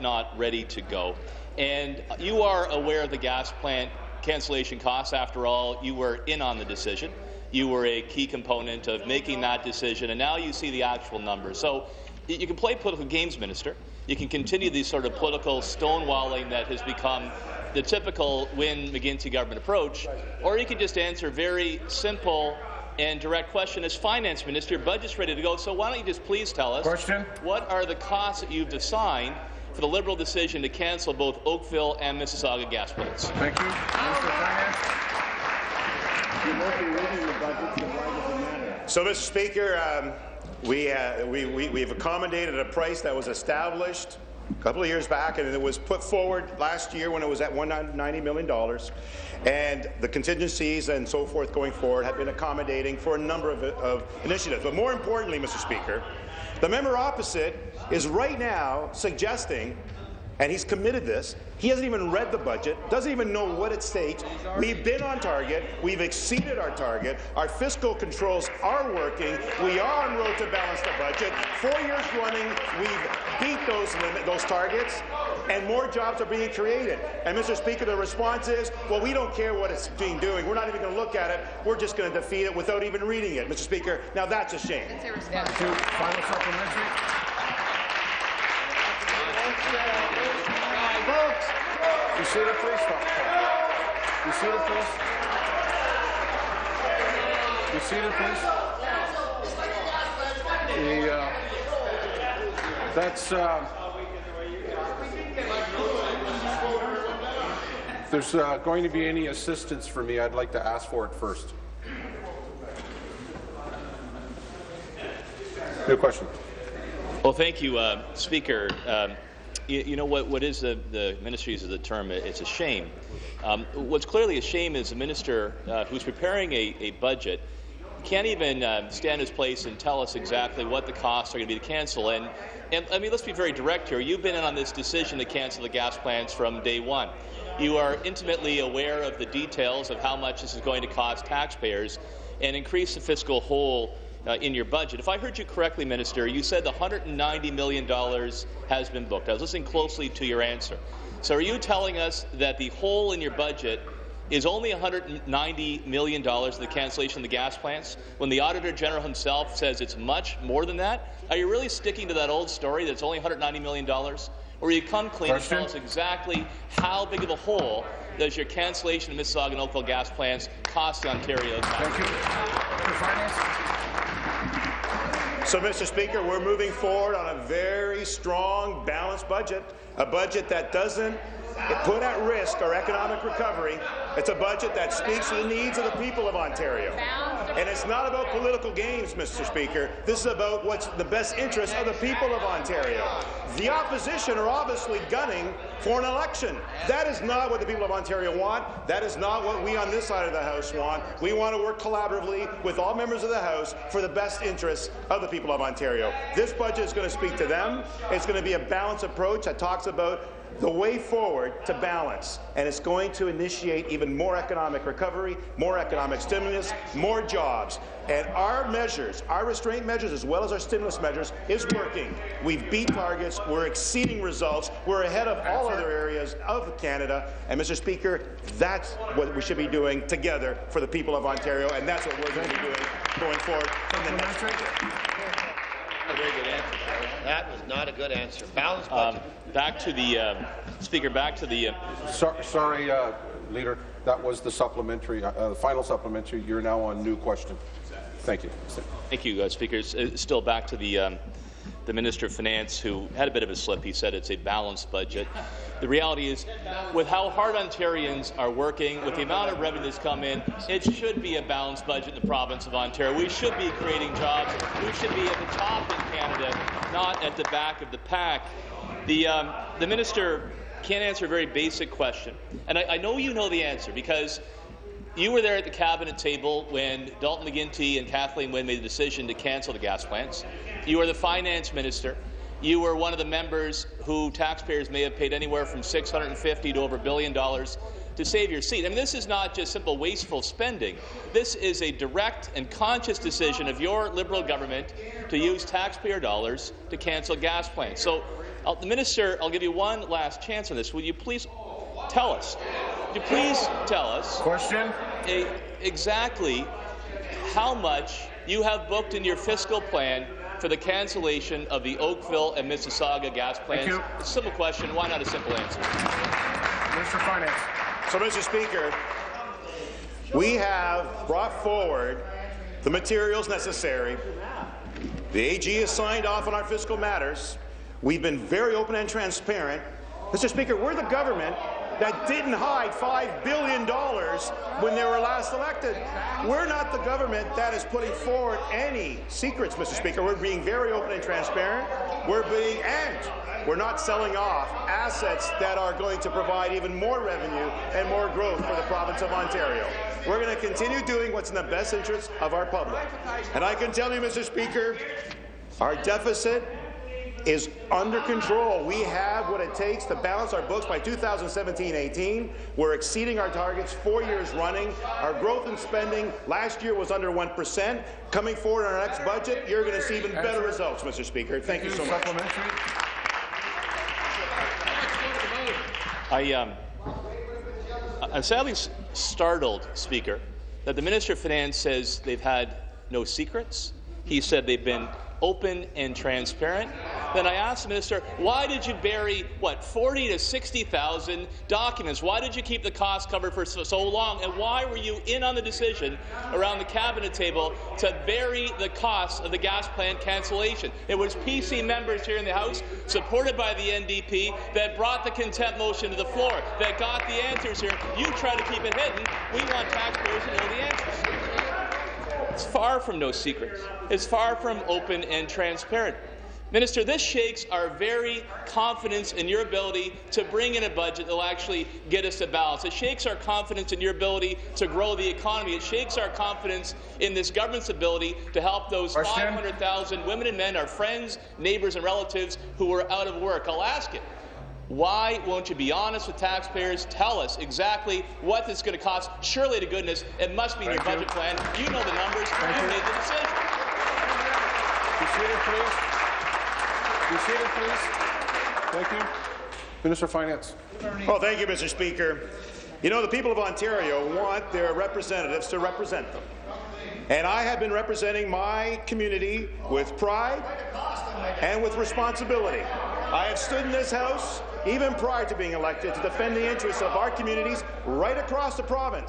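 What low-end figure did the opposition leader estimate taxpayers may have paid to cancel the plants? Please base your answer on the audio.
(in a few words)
650.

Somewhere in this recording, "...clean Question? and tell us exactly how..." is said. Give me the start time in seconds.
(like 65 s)
165 s.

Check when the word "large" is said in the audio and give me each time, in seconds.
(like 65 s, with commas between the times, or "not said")
not said.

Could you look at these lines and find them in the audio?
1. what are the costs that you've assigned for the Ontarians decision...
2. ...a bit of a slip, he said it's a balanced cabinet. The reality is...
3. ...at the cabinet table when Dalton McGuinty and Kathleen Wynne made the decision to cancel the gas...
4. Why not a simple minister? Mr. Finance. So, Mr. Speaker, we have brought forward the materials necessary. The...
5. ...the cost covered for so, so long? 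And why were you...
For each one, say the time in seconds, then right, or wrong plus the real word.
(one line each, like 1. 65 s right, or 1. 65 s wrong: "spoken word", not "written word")
1. 27 s wrong: "Liberal", not "Ontarians"
2. 253 s wrong: "budget", not "cabinet"
3. 275 s right
4. 314 s wrong: "answer", not "minister"
5. 392 s right.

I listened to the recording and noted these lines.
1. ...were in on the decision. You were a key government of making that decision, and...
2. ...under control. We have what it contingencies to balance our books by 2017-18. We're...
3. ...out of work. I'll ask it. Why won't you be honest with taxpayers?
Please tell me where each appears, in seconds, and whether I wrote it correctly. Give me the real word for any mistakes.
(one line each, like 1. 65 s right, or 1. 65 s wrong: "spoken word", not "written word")
1. 5 s wrong: "component", not "government"
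2. 357 s wrong: "takes", not "contingencies"
3. 433 s right.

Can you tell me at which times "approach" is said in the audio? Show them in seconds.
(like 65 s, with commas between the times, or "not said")
19 s, 209 s.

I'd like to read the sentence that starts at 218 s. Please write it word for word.
And our measures, our restraint measures as well as our stimulus measures, is working.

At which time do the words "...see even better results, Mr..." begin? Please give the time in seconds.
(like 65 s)
370 s.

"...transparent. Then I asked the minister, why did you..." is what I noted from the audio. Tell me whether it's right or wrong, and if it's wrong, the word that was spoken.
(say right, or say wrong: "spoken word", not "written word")
right.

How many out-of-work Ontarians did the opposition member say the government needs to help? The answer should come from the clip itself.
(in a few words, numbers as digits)
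500,000.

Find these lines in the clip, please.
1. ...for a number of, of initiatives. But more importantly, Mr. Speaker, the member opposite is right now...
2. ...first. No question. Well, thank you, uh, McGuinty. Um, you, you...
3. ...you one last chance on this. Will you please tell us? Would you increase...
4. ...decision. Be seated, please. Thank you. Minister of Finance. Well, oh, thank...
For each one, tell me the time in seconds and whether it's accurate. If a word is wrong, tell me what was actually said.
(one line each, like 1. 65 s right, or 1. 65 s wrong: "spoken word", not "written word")
1. 52 s right
2. 111 s wrong: "Speaker", not "McGuinty"
3. 299 s wrong: "please", not "increase"
4. 445 s right.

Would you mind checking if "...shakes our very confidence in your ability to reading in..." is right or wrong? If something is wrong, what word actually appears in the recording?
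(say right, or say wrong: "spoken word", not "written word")
wrong: "bring", not "reading".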